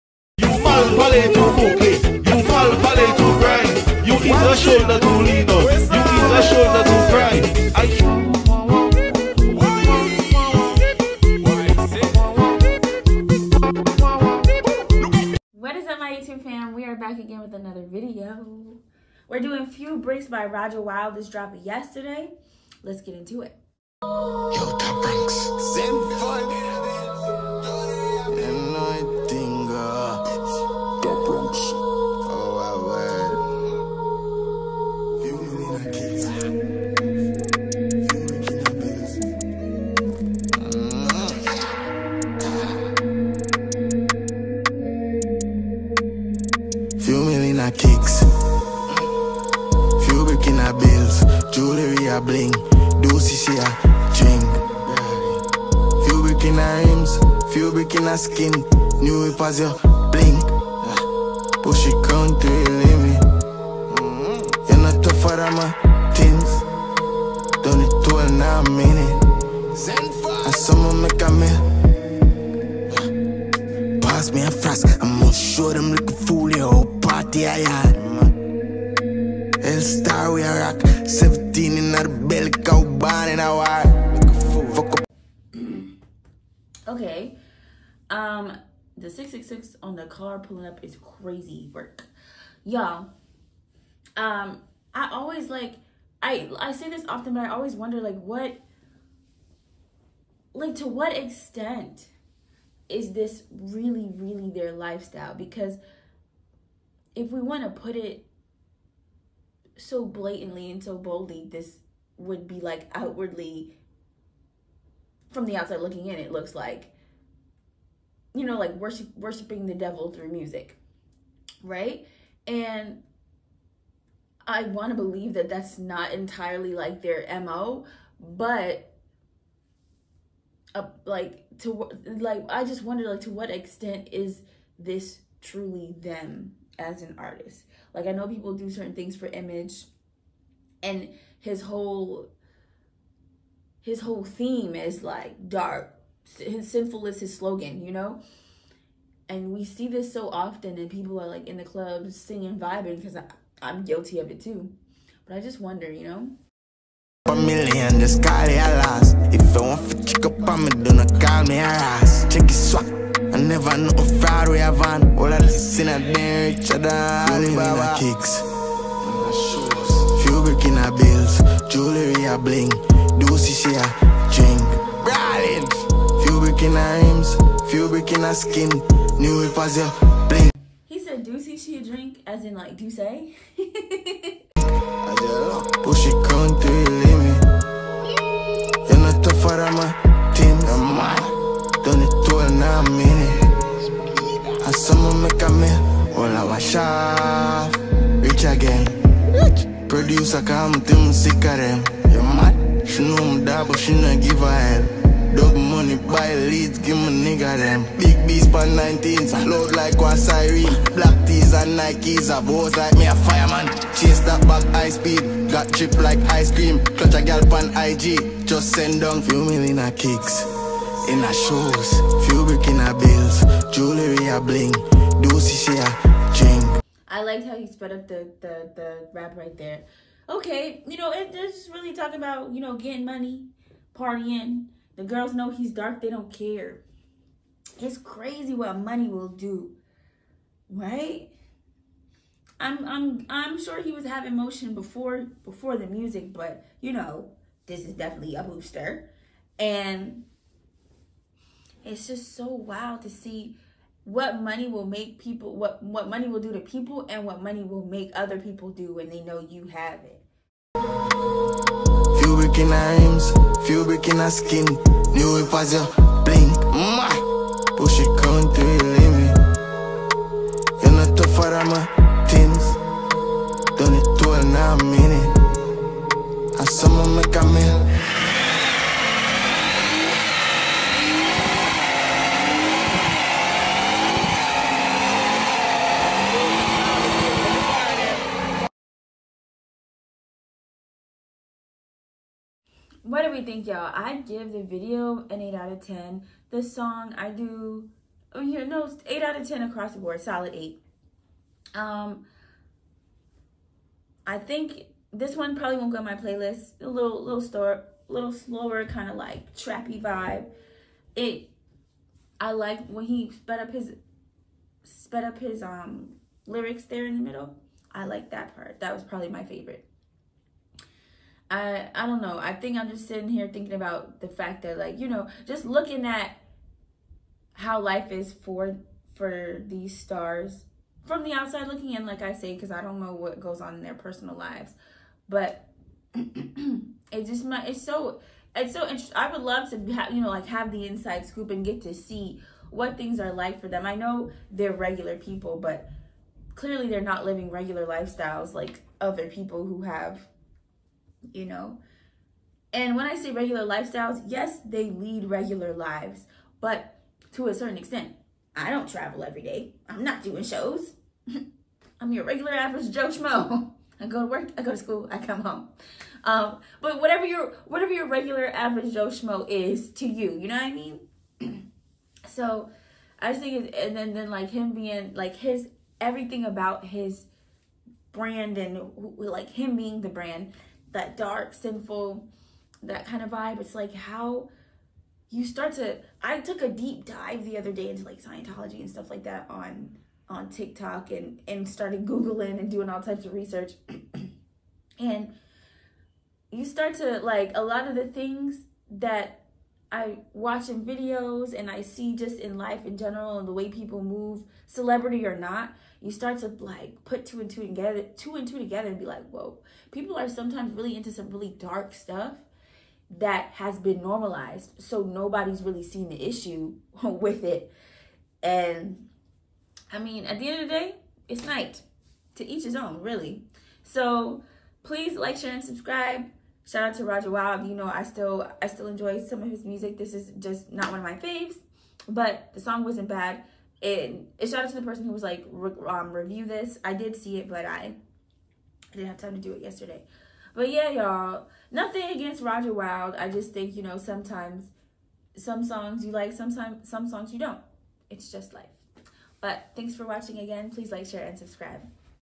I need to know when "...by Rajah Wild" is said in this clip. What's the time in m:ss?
0:20.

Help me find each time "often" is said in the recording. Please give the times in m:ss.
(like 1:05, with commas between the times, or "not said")
1:37, 2:30.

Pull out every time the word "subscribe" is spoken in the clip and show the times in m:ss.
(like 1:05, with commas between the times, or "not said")
7:05, 7:31.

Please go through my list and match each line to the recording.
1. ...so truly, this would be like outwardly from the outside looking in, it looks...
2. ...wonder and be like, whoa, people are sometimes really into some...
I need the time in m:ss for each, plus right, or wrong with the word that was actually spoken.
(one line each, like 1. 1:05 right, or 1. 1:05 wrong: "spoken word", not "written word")
1. 1:50 wrong: "boldly", not "truly"
2. 6:48 wrong: "together", not "wonder".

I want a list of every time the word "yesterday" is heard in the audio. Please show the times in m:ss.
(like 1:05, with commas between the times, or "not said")
0:21, 7:19.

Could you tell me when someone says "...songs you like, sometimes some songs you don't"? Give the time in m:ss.
7:25.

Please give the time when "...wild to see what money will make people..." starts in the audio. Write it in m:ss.
4:12.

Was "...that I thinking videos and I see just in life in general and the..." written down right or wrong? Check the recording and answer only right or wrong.
wrong.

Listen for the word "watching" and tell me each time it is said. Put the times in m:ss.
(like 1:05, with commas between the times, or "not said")
6:40, 7:30.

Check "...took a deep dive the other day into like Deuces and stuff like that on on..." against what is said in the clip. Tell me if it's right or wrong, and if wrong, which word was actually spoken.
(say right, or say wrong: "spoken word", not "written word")
wrong: "Scientology", not "Deuces".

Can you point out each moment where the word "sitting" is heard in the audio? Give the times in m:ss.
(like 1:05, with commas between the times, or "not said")
5:23.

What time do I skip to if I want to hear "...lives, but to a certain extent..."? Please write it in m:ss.
5:55.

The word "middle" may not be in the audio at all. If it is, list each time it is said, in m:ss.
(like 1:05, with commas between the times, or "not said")
5:17.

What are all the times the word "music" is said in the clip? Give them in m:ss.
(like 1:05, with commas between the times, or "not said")
2:00, 4:05, 7:09.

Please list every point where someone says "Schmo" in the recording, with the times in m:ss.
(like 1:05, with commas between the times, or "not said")
6:03, 6:09.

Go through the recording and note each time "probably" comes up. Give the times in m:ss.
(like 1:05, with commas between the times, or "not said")
5:05, 5:19.